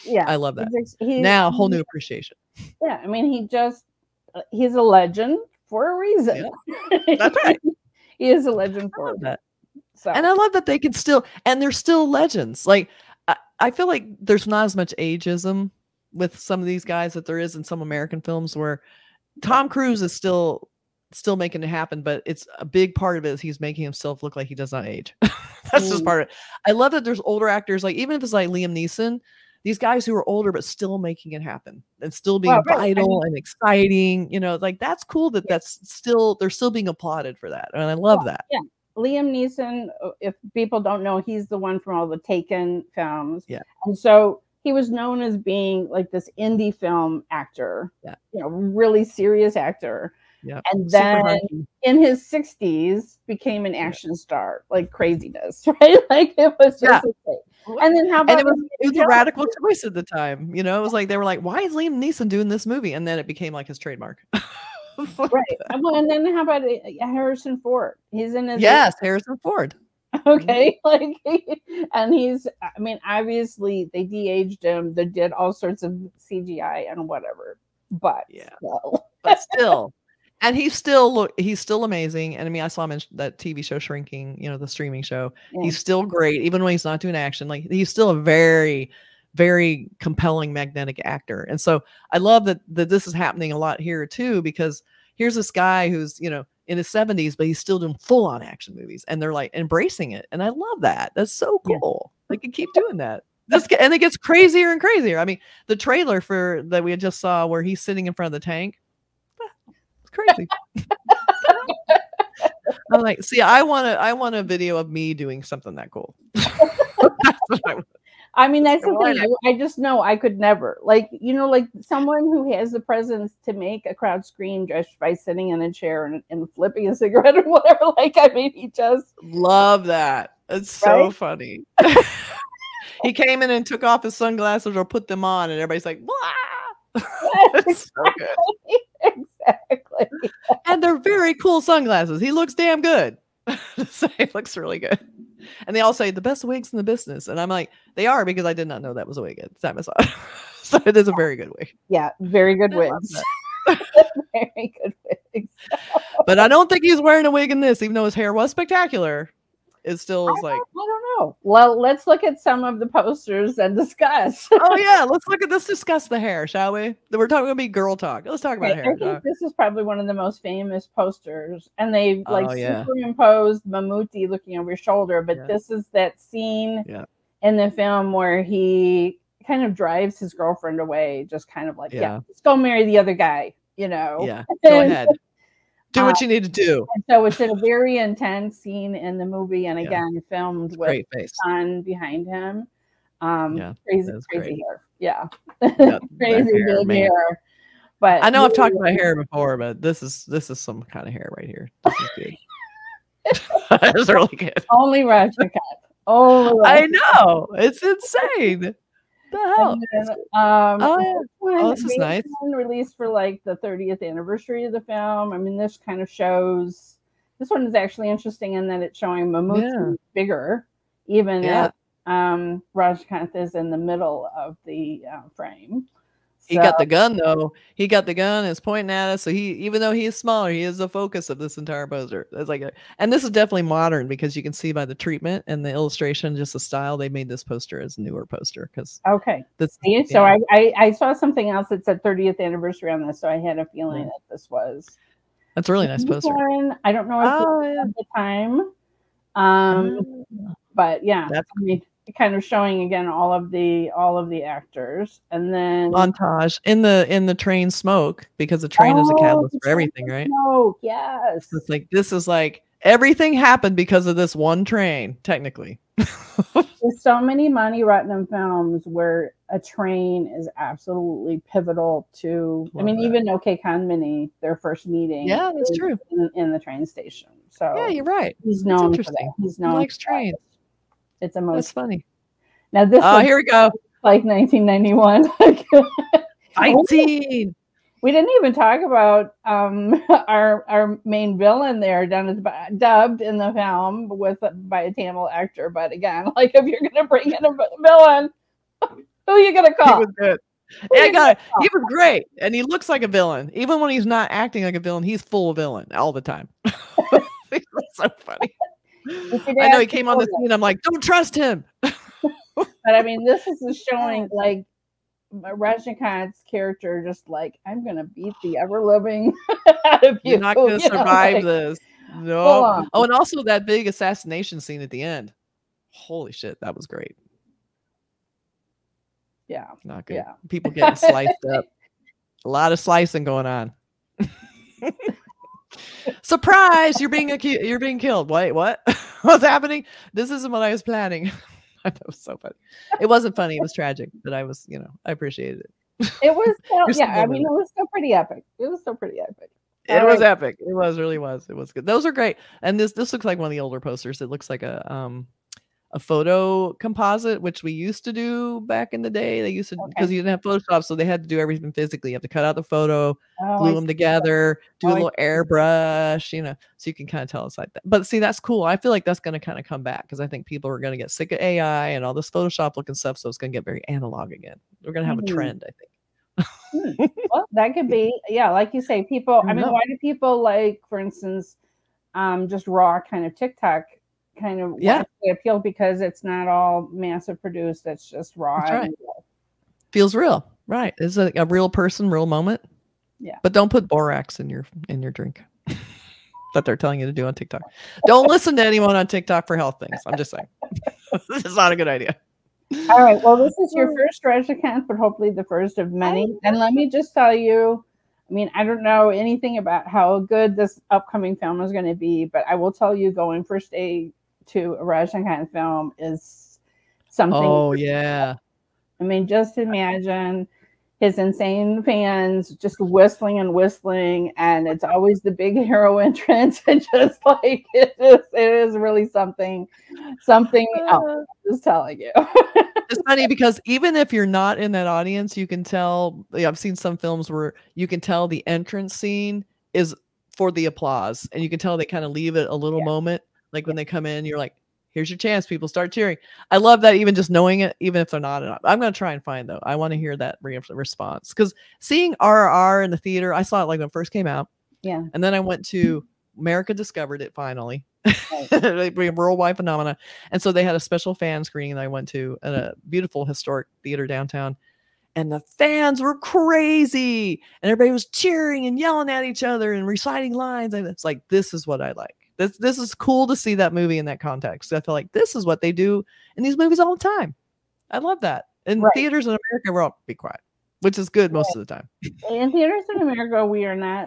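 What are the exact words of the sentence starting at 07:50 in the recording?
And it's like, this is what I like.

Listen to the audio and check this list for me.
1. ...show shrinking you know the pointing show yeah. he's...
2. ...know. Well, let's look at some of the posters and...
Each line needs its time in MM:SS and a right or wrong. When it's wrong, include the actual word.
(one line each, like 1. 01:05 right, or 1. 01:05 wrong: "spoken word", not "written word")
1. 01:23 wrong: "streaming", not "pointing"
2. 02:41 right.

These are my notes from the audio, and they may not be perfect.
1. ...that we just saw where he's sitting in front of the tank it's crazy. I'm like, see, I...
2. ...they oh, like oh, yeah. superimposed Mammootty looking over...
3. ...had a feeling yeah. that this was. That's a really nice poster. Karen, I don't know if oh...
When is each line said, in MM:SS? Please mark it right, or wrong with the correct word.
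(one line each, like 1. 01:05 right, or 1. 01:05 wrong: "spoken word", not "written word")
1. 01:46 right
2. 02:51 right
3. 04:03 right.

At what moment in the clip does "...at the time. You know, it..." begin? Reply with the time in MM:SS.
00:59.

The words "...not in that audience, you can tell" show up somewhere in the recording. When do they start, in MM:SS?
07:14.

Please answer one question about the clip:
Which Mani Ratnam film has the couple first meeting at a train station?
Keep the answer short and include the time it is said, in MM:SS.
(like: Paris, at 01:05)
OK Kanmani, at 04:33.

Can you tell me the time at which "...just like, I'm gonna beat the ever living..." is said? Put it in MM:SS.
05:17.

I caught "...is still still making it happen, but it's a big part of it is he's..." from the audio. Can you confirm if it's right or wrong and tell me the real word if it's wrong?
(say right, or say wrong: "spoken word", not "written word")
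right.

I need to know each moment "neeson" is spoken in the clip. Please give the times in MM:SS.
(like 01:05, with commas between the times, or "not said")
00:28, 00:39, 01:02.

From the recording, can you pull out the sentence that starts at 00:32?
vital I mean, and exciting you know like that's cool that yeah.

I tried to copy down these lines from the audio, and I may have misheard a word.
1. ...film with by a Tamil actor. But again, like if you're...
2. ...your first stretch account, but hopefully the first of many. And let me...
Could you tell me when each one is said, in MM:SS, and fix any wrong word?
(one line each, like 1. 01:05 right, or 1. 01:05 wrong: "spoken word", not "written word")
1. 04:53 right
2. 06:43 right.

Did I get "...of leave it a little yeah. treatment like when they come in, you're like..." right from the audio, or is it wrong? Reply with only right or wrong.
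wrong.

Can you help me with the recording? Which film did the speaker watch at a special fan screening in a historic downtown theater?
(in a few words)
RRR.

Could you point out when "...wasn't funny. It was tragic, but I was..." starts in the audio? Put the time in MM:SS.
05:43.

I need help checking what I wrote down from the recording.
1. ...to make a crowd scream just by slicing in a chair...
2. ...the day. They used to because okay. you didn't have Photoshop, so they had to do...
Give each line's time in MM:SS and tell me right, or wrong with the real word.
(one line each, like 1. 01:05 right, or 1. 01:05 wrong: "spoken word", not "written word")
1. 02:03 wrong: "sitting", not "slicing"
2. 05:59 right.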